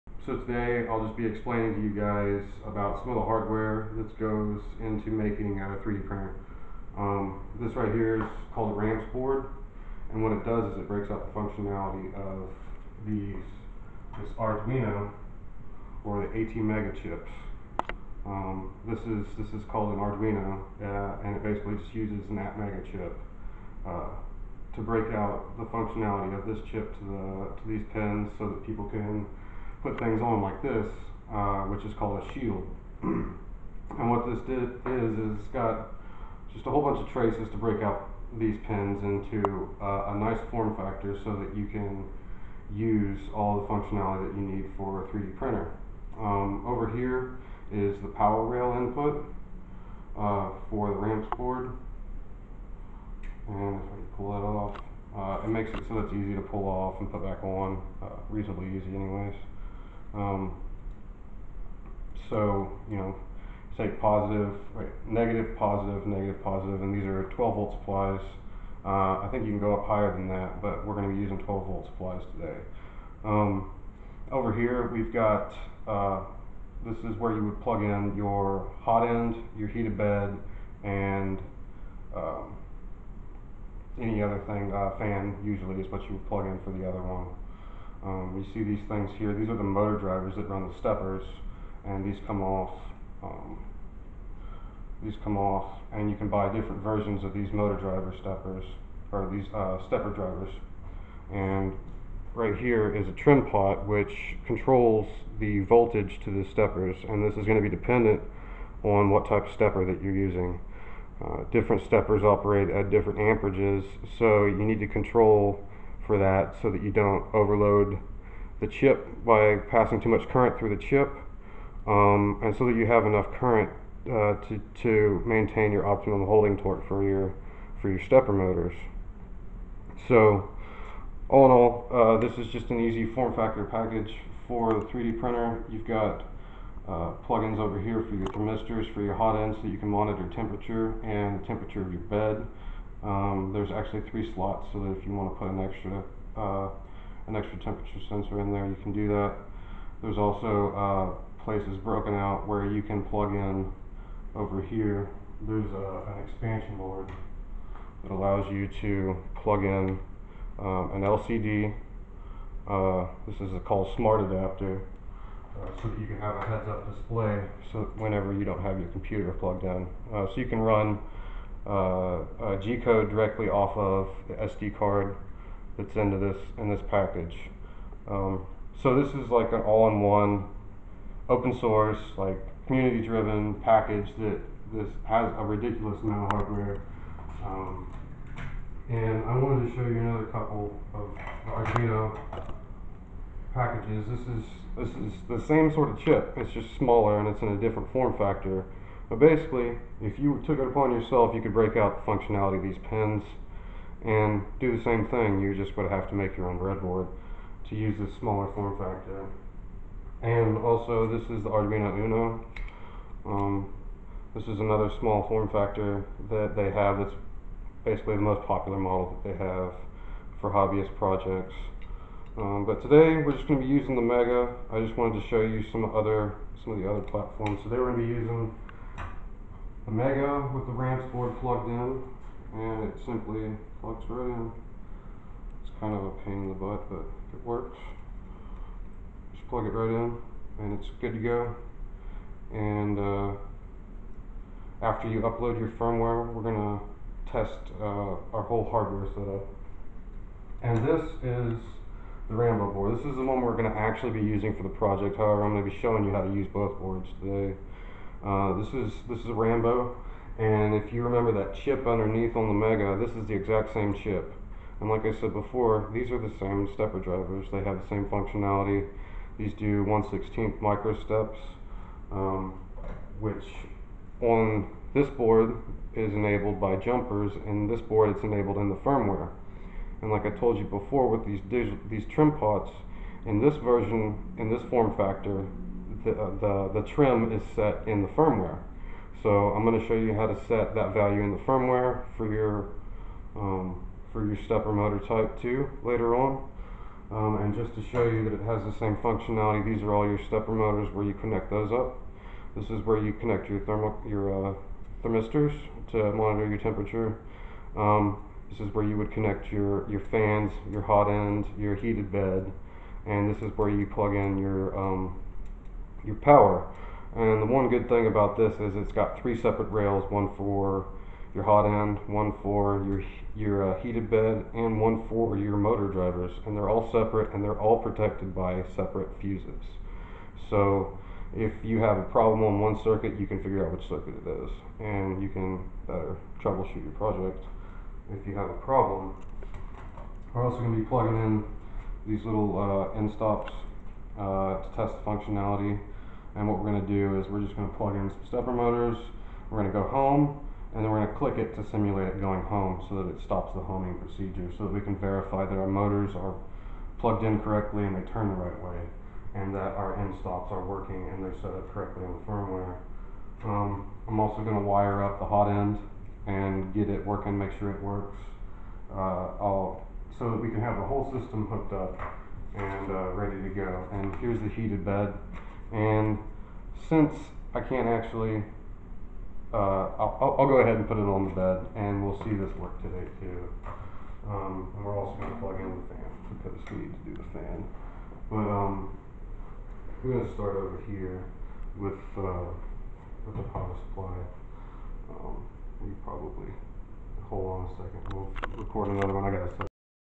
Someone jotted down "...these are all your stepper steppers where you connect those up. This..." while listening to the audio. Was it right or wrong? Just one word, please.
wrong.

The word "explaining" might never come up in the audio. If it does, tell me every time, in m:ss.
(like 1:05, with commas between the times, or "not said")
0:01.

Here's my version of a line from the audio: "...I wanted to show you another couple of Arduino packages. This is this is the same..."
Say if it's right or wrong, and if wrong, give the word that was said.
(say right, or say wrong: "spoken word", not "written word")
right.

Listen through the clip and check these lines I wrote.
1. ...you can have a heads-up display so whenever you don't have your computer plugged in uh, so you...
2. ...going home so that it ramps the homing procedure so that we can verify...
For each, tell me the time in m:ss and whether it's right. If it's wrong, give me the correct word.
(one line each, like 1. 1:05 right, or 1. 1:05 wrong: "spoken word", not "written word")
1. 2:45 right
2. 5:52 wrong: "stops", not "ramps".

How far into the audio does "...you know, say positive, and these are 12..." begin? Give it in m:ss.
1:02.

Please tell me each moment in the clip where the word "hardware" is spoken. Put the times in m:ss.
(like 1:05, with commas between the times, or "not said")
0:03, 3:06, 4:08.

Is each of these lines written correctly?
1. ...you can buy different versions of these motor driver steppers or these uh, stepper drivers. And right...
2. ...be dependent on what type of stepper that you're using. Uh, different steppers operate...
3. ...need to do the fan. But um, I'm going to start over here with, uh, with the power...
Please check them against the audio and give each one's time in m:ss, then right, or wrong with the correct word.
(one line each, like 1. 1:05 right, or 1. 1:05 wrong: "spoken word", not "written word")
1. 1:36 right
2. 1:47 right
3. 6:26 right.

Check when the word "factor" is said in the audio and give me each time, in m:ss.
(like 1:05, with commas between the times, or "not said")
0:40, 2:13, 3:18, 3:28, 3:35, 4:44.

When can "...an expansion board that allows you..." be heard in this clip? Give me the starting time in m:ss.
2:36.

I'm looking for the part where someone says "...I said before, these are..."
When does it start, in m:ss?
4:25.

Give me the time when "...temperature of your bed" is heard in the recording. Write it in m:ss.
2:21.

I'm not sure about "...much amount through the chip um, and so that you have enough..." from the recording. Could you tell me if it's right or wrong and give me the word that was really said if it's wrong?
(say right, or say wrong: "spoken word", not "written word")
wrong: "current", not "amount".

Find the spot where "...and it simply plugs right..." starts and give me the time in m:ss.
3:52.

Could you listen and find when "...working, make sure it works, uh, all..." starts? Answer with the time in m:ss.
6:07.